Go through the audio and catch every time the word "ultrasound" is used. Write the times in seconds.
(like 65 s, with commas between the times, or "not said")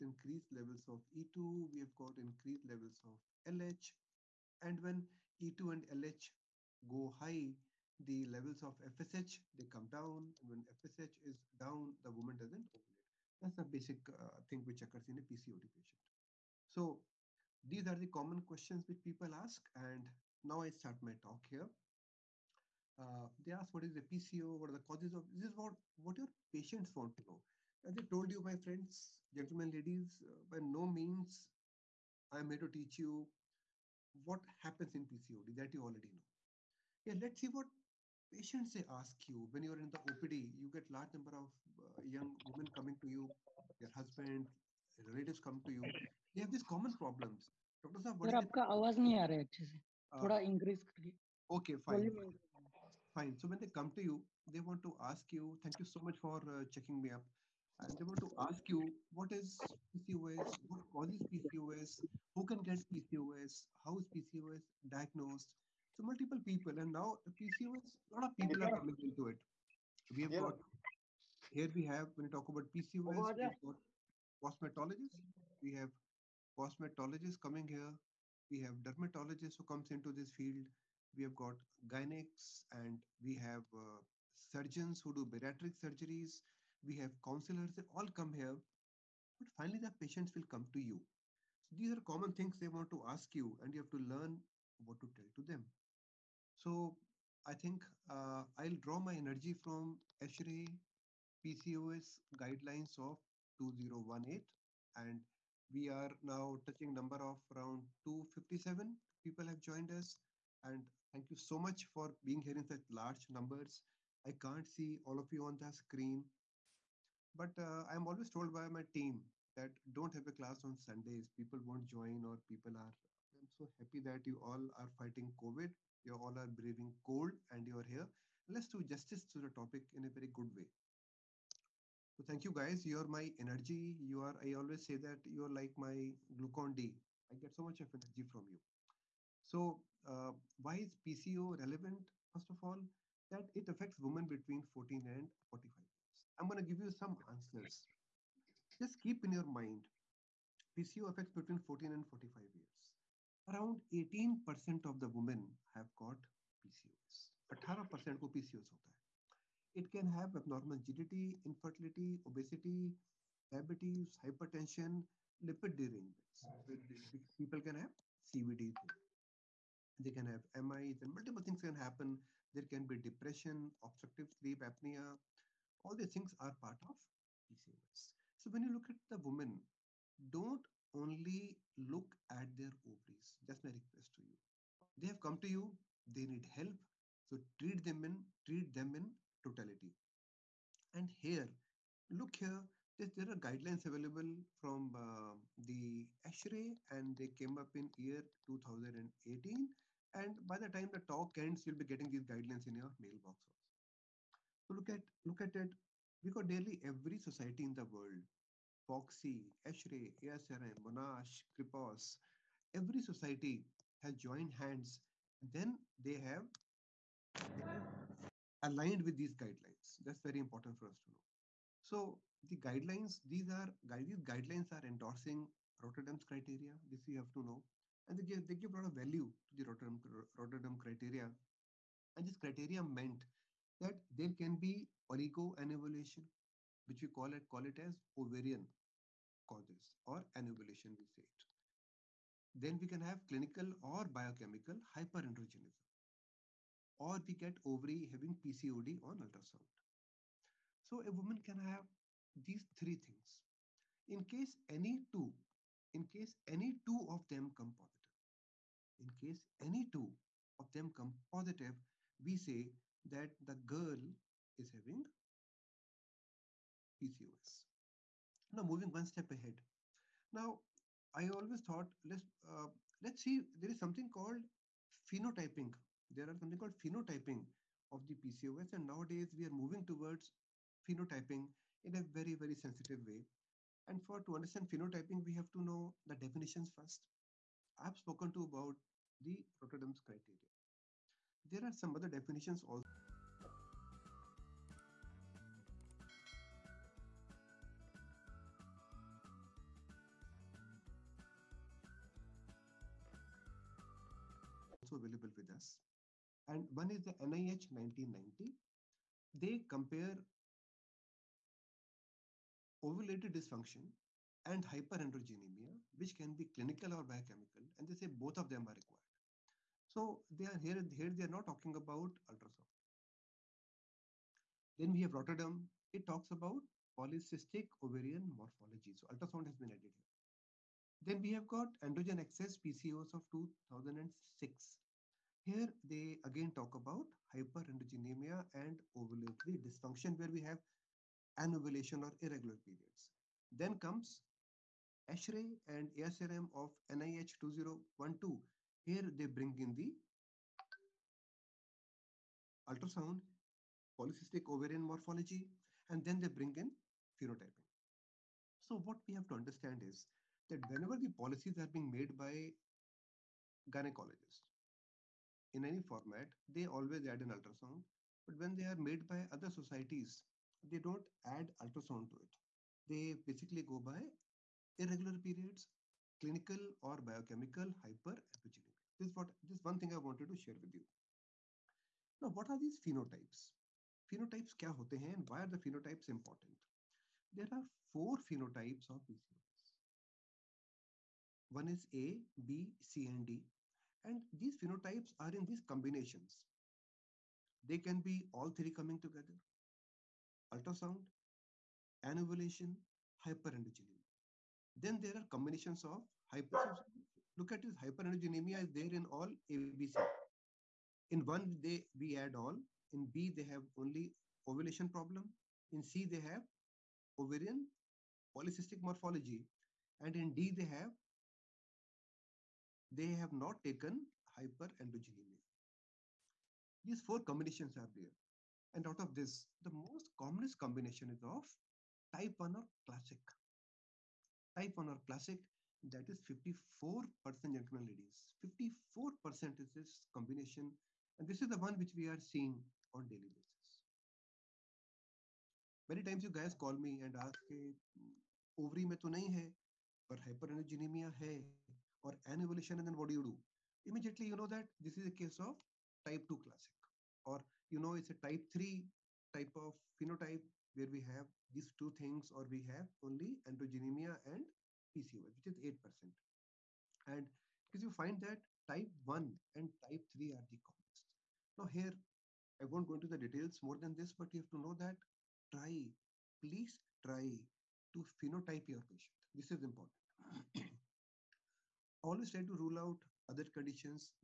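249 s, 322 s, 329 s, 352 s, 367 s, 371 s, 400 s.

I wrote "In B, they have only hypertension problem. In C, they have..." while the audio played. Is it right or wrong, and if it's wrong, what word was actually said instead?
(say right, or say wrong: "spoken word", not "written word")
wrong: "ovulation", not "hypertension".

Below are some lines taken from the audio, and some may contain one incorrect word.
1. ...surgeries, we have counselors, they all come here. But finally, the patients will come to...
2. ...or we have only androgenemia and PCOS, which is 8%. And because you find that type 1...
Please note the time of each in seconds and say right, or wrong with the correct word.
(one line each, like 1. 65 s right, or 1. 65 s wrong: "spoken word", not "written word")
1. 85 s right
2. 462 s right.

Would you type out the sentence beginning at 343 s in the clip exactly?
Then comes ESHRE and ASRM of NIH 2012.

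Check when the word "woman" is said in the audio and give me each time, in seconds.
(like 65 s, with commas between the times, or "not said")
12 s, 179 s, 251 s.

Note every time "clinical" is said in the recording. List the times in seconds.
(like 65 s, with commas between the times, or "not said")
243 s, 316 s, 376 s.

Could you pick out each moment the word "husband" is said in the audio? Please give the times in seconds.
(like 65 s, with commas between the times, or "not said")
43 s.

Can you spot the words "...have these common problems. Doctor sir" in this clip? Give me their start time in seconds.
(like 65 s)
46 s.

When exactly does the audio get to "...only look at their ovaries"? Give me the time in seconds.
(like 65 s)
180 s.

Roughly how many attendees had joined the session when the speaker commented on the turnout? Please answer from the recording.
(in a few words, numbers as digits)
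257.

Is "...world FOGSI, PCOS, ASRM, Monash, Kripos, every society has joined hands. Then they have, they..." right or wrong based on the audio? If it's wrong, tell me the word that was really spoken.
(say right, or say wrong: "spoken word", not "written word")
wrong: "ESHRE", not "PCOS".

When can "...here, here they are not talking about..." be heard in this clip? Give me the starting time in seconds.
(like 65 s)
320 s.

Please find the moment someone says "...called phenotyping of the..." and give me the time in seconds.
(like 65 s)
276 s.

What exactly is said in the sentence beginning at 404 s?
Then there are combinations of hyper.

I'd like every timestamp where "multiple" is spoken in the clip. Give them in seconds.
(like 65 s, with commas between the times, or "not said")
66 s, 171 s.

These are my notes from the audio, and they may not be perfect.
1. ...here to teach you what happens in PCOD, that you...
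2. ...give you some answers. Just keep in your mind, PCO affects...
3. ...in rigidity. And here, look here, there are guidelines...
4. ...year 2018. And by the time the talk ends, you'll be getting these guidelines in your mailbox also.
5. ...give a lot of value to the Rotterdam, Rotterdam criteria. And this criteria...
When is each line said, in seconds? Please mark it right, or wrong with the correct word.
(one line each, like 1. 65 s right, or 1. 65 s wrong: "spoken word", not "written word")
1. 32 s right
2. 146 s right
3. 188 s wrong: "totality", not "rigidity"
4. 197 s right
5. 228 s right.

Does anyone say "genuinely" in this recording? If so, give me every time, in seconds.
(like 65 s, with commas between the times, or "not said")
not said.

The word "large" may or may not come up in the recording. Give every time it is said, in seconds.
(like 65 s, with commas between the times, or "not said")
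40 s, 112 s.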